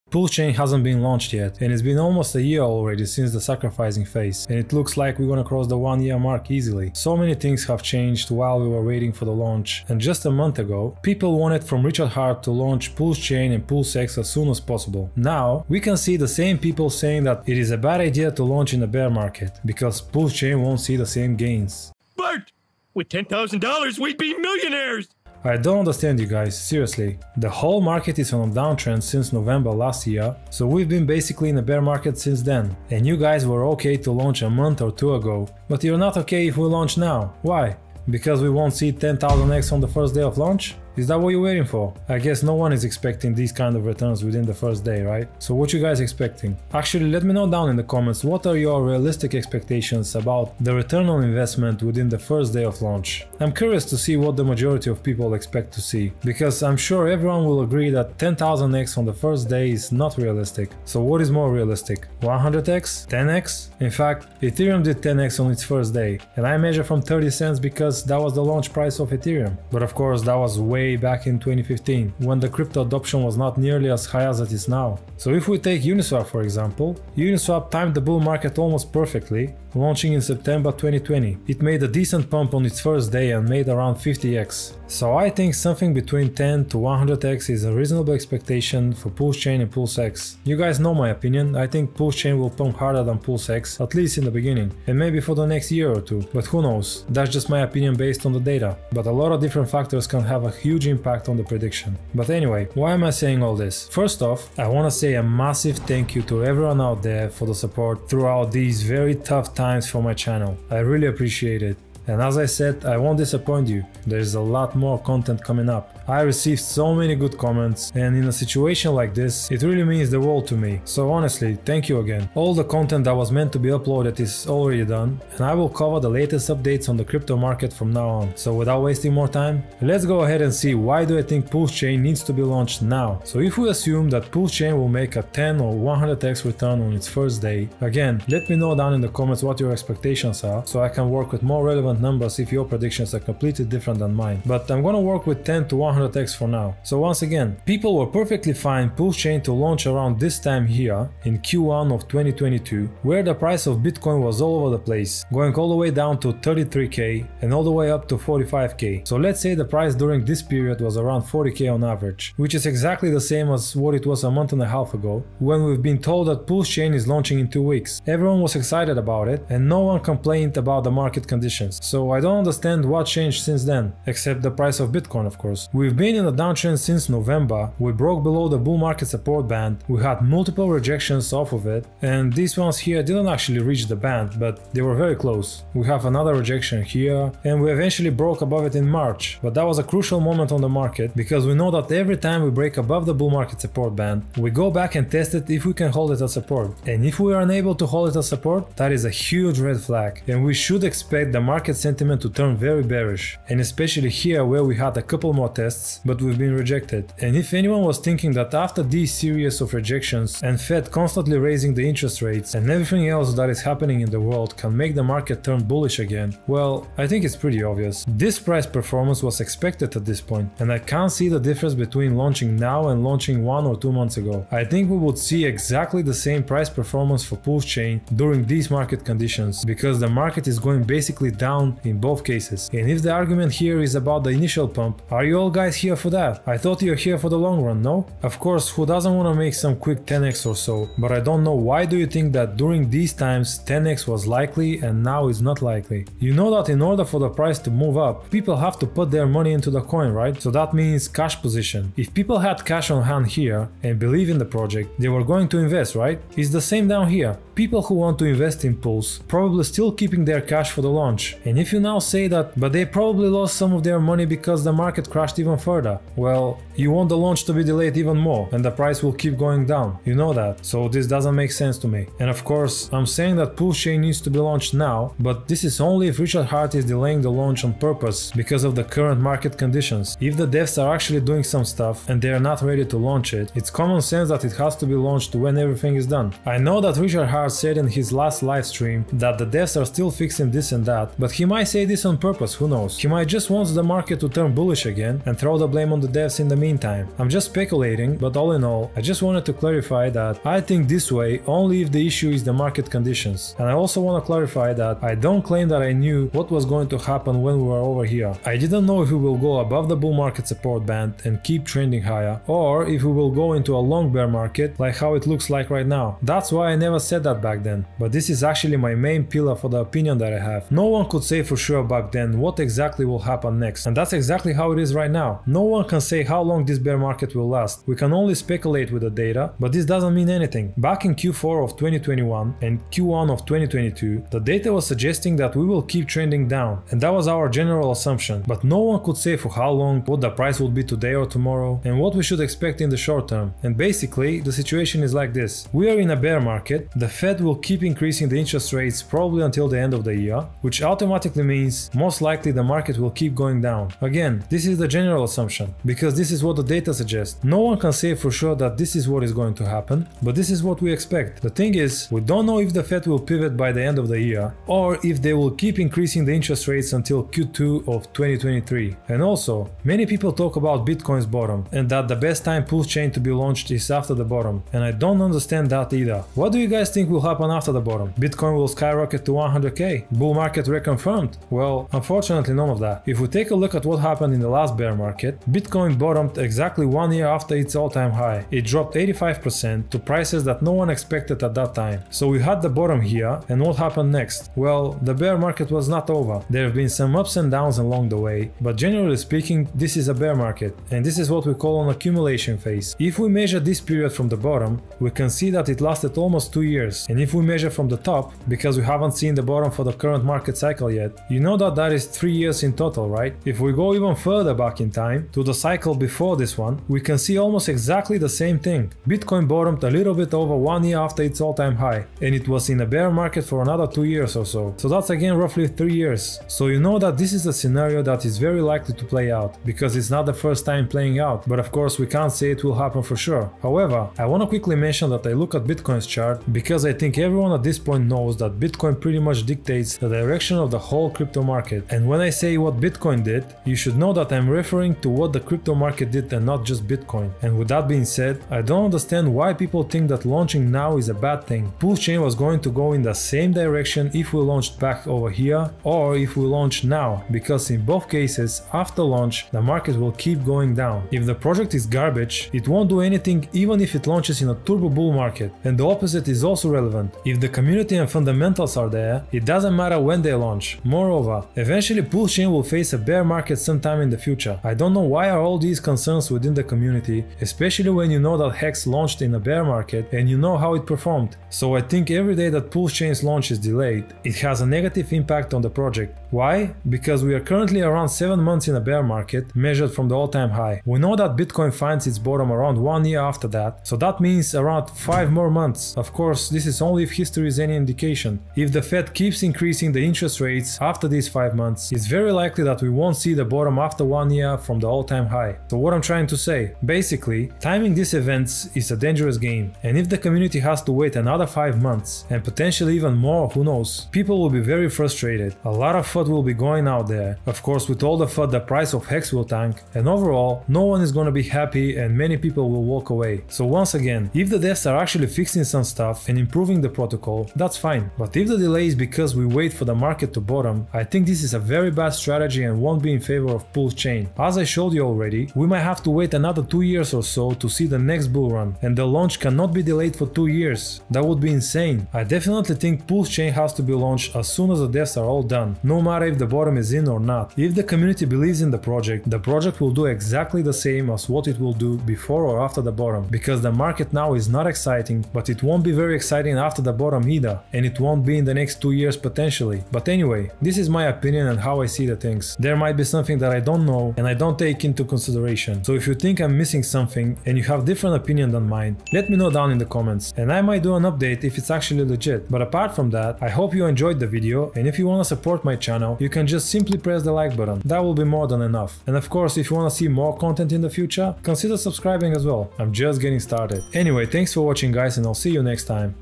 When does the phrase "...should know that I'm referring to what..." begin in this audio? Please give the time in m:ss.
7:23.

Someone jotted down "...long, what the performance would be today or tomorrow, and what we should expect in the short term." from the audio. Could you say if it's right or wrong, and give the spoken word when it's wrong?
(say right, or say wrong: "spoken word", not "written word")
wrong: "price", not "performance".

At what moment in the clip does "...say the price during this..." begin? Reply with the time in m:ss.
2:39.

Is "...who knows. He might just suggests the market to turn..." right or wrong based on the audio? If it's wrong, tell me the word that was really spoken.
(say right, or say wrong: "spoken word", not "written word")
wrong: "wants", not "suggests".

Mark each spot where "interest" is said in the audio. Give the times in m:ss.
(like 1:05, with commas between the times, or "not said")
3:31, 5:48, 6:06, 8:20.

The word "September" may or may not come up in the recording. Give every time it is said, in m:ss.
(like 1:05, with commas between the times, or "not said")
1:20.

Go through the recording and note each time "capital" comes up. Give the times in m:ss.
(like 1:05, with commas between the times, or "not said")
not said.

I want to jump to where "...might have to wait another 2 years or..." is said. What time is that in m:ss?
8:55.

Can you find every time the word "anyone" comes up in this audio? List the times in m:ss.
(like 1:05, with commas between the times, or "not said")
3:27.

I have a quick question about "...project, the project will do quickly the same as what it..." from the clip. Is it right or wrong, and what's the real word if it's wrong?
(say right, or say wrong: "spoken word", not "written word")
wrong: "exactly", not "quickly".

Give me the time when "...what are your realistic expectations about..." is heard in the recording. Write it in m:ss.
0:48.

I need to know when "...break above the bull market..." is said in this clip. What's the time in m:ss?
3:12.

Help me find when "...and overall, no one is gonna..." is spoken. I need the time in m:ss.
8:39.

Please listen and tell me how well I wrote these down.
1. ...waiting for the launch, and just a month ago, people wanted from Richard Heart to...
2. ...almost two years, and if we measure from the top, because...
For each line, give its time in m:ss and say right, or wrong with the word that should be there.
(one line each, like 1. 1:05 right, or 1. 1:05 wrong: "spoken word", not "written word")
1. 0:08 right
2. 6:46 right.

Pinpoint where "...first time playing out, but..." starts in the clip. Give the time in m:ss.
7:10.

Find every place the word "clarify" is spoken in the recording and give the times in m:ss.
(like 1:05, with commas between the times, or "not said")
4:59, 5:04.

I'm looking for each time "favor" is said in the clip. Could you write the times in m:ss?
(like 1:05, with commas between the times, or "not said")
8:53.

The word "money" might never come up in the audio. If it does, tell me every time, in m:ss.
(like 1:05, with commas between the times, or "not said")
4:09, 4:23.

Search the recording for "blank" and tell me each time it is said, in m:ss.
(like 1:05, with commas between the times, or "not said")
not said.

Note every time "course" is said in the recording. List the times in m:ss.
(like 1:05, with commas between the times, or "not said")
1:09, 2:55, 3:58, 4:32, 7:11, 8:16, 8:37, 9:39.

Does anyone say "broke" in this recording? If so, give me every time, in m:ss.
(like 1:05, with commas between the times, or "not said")
2:57, 3:08.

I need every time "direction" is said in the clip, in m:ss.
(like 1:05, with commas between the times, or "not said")
7:20, 7:33.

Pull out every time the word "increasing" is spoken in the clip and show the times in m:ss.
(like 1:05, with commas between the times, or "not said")
5:47, 6:05, 8:19.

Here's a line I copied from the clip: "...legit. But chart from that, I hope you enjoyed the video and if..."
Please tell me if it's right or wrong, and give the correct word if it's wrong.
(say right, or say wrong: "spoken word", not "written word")
wrong: "apart", not "chart".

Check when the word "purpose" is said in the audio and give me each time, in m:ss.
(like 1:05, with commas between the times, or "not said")
4:37, 4:52.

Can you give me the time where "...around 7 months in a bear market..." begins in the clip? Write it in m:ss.
8:07.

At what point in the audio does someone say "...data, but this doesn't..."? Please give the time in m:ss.
5:29.